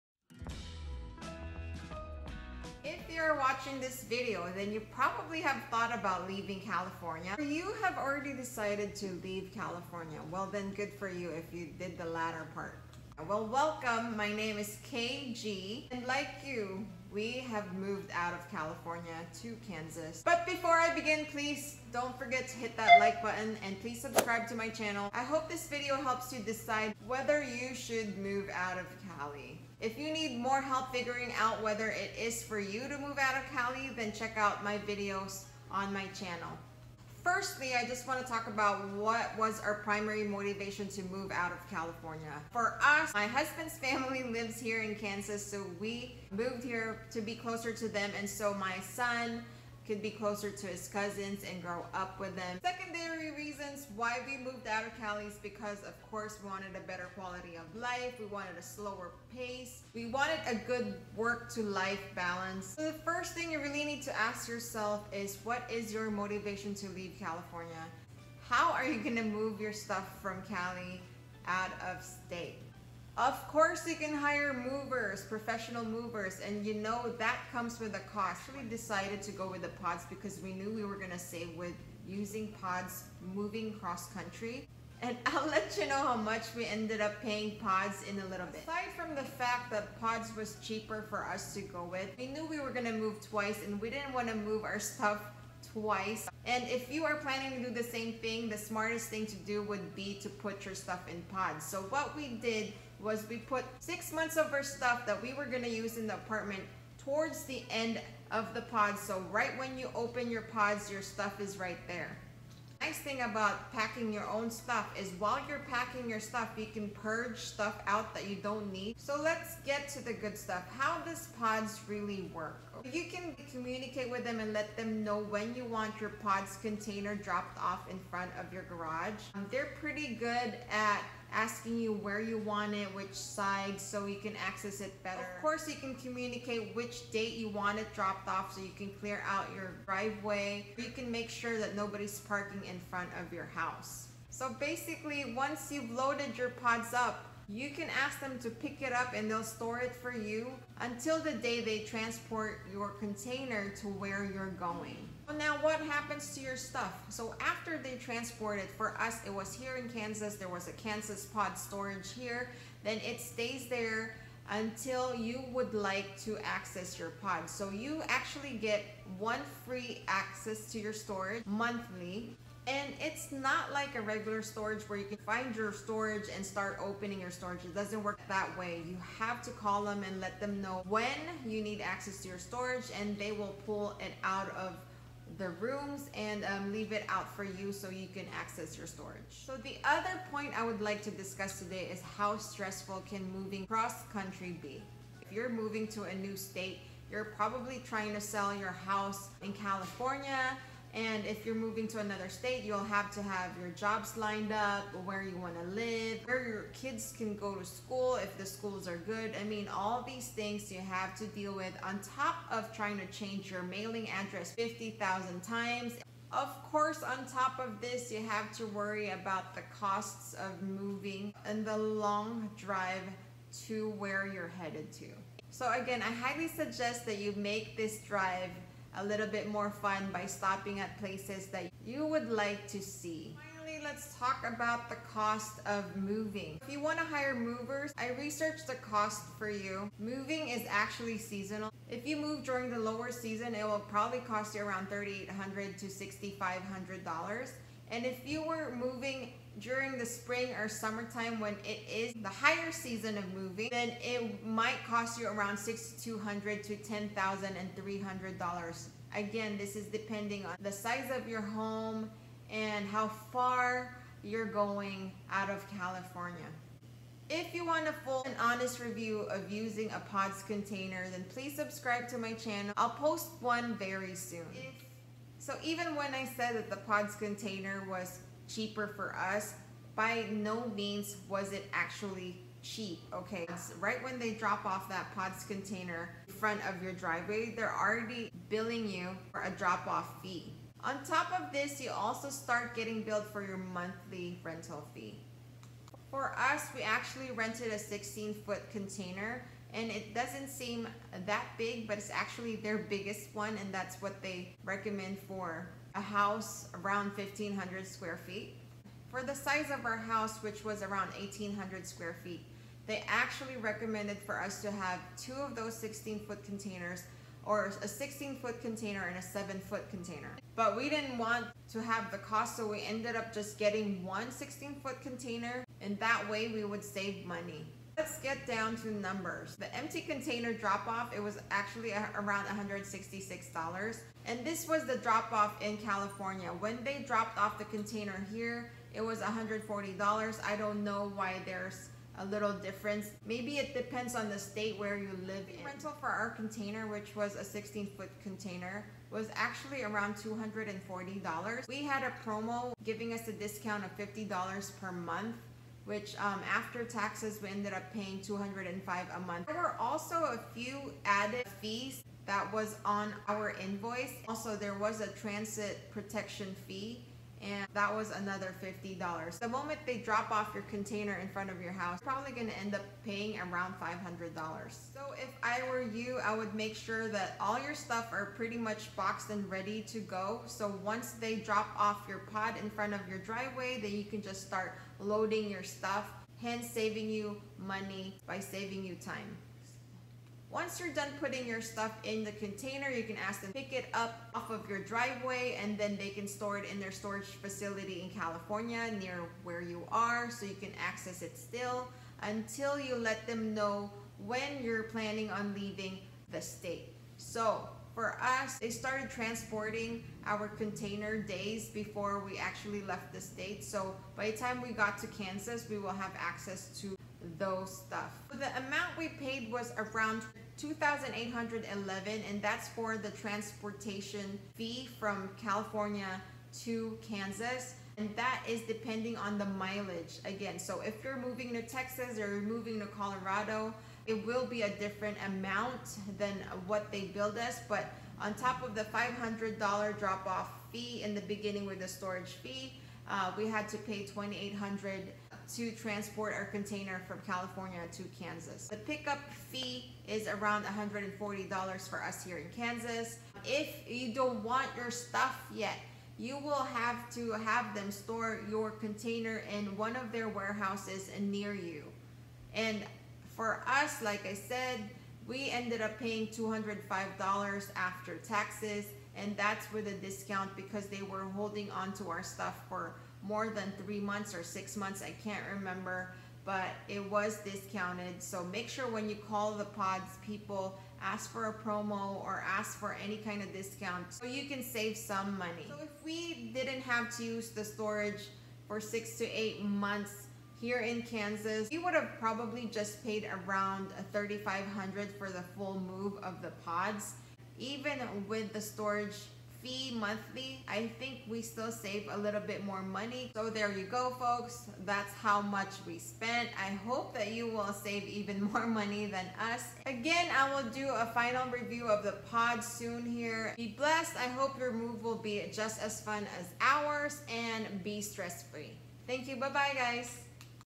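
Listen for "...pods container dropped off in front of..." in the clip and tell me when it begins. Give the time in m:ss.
2:06.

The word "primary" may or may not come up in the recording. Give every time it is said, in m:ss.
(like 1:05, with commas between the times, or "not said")
0:39.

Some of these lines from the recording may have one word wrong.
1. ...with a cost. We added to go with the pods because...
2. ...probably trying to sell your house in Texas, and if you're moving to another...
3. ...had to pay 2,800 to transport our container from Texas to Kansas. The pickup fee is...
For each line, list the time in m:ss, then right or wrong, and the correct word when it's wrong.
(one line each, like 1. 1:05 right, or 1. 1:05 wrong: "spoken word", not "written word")
1. 1:17 wrong: "decided", not "added"
2. 3:17 wrong: "California", not "Texas"
3. 7:23 wrong: "California", not "Texas".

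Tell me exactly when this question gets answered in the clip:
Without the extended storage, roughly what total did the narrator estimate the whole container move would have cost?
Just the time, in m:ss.
8:14.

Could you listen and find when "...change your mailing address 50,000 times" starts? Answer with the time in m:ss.
3:33.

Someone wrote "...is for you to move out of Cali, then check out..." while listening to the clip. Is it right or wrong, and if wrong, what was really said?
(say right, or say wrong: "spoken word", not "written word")
right.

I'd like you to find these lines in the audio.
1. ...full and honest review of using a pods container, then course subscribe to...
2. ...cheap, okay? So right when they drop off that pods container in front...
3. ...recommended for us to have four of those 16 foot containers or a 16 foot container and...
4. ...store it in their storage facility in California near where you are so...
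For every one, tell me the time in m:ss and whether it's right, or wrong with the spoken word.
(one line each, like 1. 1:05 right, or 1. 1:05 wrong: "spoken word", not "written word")
1. 4:27 wrong: "please", not "course"
2. 4:42 right
3. 5:13 wrong: "two", not "four"
4. 6:36 right.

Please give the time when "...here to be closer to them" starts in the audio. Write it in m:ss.
0:46.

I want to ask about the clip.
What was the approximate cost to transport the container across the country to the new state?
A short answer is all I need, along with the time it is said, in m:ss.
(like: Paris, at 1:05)
$2,811, at 7:00.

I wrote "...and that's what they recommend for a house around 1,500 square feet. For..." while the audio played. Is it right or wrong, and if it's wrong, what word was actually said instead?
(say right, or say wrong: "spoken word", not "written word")
right.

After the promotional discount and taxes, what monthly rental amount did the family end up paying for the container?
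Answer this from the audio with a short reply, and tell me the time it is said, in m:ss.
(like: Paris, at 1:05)
$205, at 5:58.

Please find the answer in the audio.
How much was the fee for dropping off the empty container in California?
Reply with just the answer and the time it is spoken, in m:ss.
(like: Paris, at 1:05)
$166, at 5:32.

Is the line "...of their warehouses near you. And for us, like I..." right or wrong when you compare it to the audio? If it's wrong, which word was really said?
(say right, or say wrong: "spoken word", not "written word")
right.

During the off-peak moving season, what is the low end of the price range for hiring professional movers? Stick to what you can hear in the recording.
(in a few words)
$3,800.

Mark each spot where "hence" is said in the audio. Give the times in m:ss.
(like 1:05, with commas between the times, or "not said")
6:26.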